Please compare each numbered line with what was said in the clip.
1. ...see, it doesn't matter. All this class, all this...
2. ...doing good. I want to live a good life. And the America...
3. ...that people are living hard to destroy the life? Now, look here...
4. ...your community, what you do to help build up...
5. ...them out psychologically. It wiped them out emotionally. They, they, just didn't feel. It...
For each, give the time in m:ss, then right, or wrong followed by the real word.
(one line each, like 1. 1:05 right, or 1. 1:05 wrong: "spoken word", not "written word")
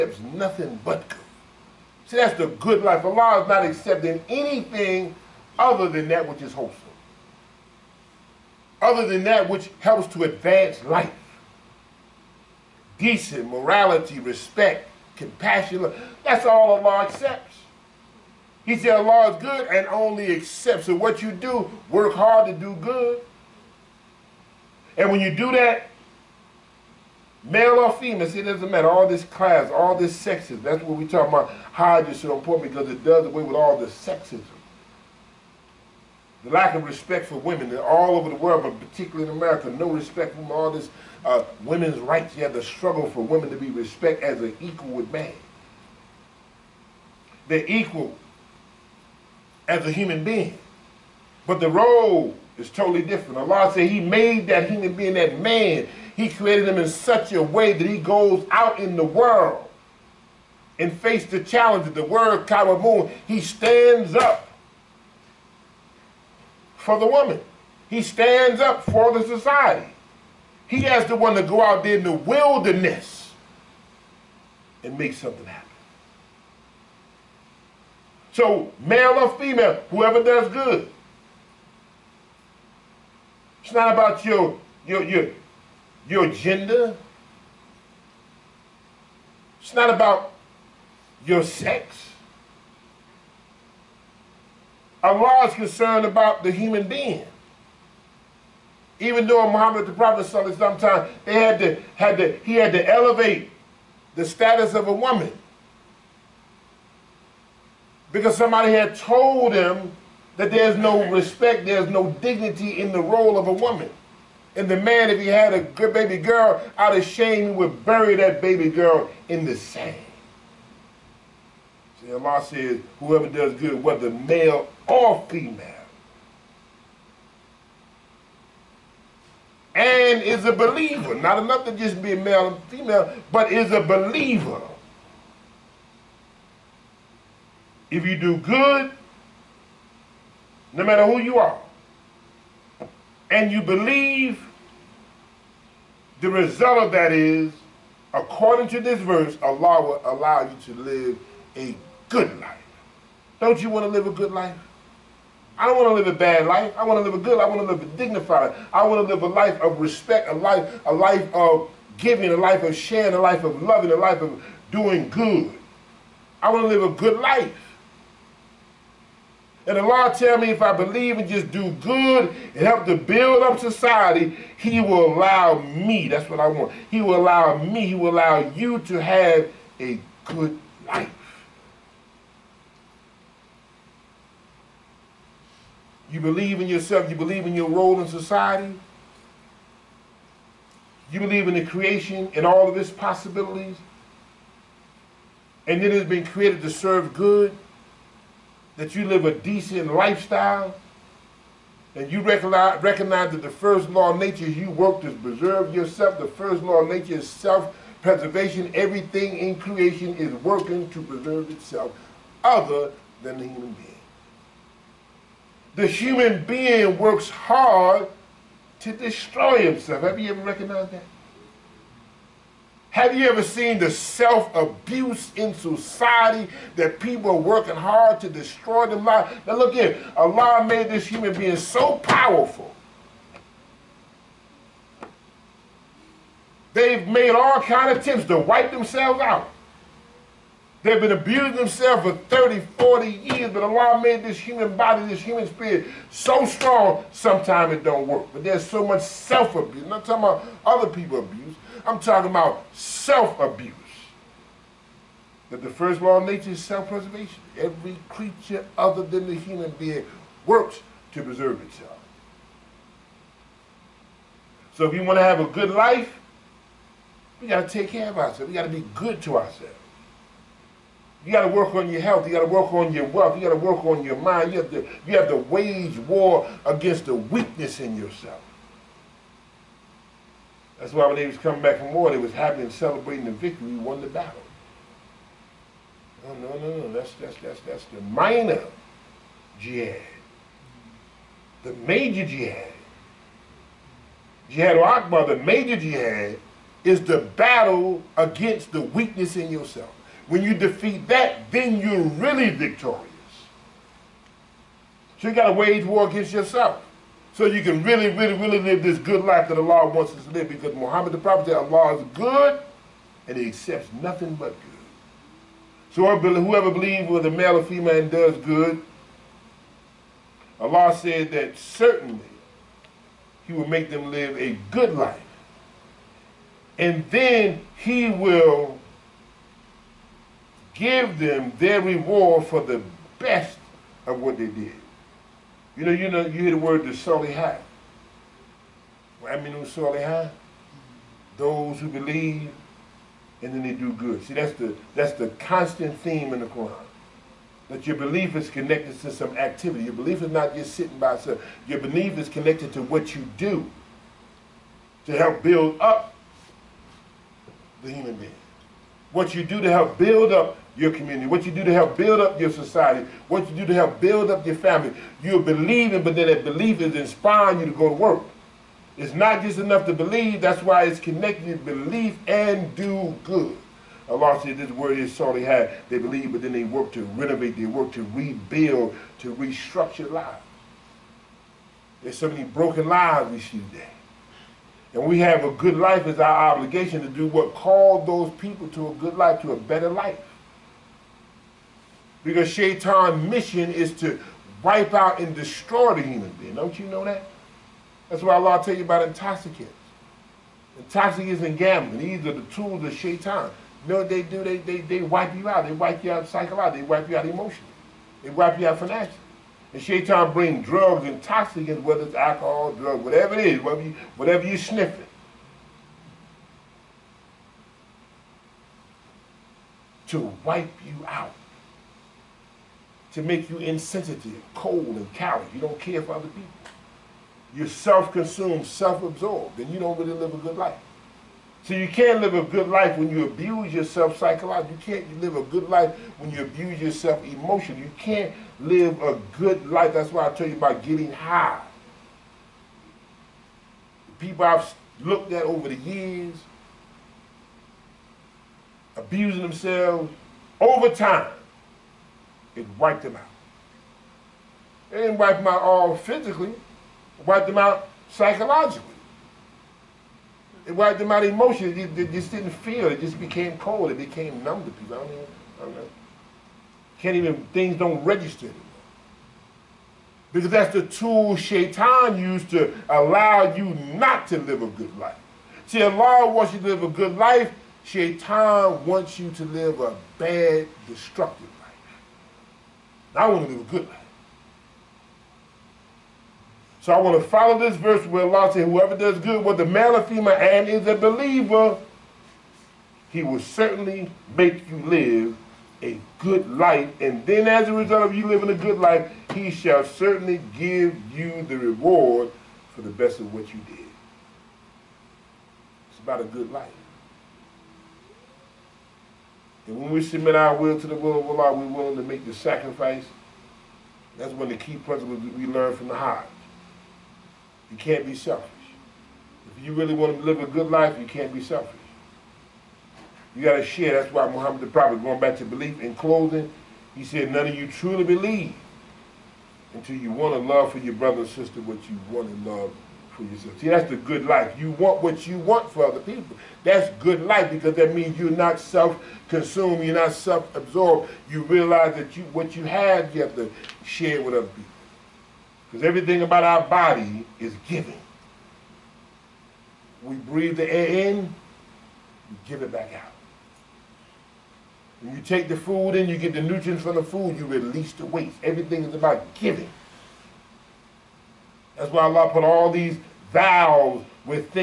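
1. 0:28 right
2. 2:44 wrong: "Lord", not "America"
3. 3:46 wrong: "working", not "living"
4. 6:00 right
5. 7:37 right.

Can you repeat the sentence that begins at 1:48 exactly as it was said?
Because somebody had told him that there's no respect, there's no dignity in the role of a woman.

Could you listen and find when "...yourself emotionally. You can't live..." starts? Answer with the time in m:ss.
7:16.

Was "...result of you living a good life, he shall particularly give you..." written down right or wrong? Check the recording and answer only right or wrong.
wrong.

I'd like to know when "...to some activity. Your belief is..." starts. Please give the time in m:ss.
5:49.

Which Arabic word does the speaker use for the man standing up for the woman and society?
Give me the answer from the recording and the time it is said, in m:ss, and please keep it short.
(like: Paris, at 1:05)
Kawamun, at 1:02.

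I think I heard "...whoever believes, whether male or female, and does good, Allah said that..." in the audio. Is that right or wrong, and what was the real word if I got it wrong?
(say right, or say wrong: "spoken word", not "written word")
right.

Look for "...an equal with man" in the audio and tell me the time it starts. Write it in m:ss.
0:44.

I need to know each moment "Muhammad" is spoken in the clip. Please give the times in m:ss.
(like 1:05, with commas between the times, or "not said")
1:39, 5:10, 8:44.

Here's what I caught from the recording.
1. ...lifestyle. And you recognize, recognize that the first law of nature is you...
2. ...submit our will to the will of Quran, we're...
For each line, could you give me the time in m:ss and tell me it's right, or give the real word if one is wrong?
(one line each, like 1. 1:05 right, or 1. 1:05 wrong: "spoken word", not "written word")
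1. 3:19 right
2. 8:30 wrong: "Allah", not "Quran".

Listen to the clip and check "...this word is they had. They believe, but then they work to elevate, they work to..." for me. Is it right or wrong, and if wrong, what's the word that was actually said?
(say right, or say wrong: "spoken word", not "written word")
wrong: "renovate", not "elevate".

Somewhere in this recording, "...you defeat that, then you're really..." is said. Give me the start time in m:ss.
5:00.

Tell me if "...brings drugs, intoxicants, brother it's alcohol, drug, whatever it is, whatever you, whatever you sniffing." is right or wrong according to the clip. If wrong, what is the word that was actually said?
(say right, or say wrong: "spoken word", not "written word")
wrong: "whether", not "brother".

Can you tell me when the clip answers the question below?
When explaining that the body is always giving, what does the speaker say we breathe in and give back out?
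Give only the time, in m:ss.
9:10.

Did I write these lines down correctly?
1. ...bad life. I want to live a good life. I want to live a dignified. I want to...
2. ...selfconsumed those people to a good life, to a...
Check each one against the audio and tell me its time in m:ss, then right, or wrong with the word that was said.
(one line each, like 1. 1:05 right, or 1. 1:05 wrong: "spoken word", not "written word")
1. 2:36 right
2. 6:27 wrong: "called", not "selfconsumed".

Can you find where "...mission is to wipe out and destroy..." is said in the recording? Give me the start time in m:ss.
6:33.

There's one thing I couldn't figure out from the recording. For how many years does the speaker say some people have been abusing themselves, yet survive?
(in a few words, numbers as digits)
30, 40 years.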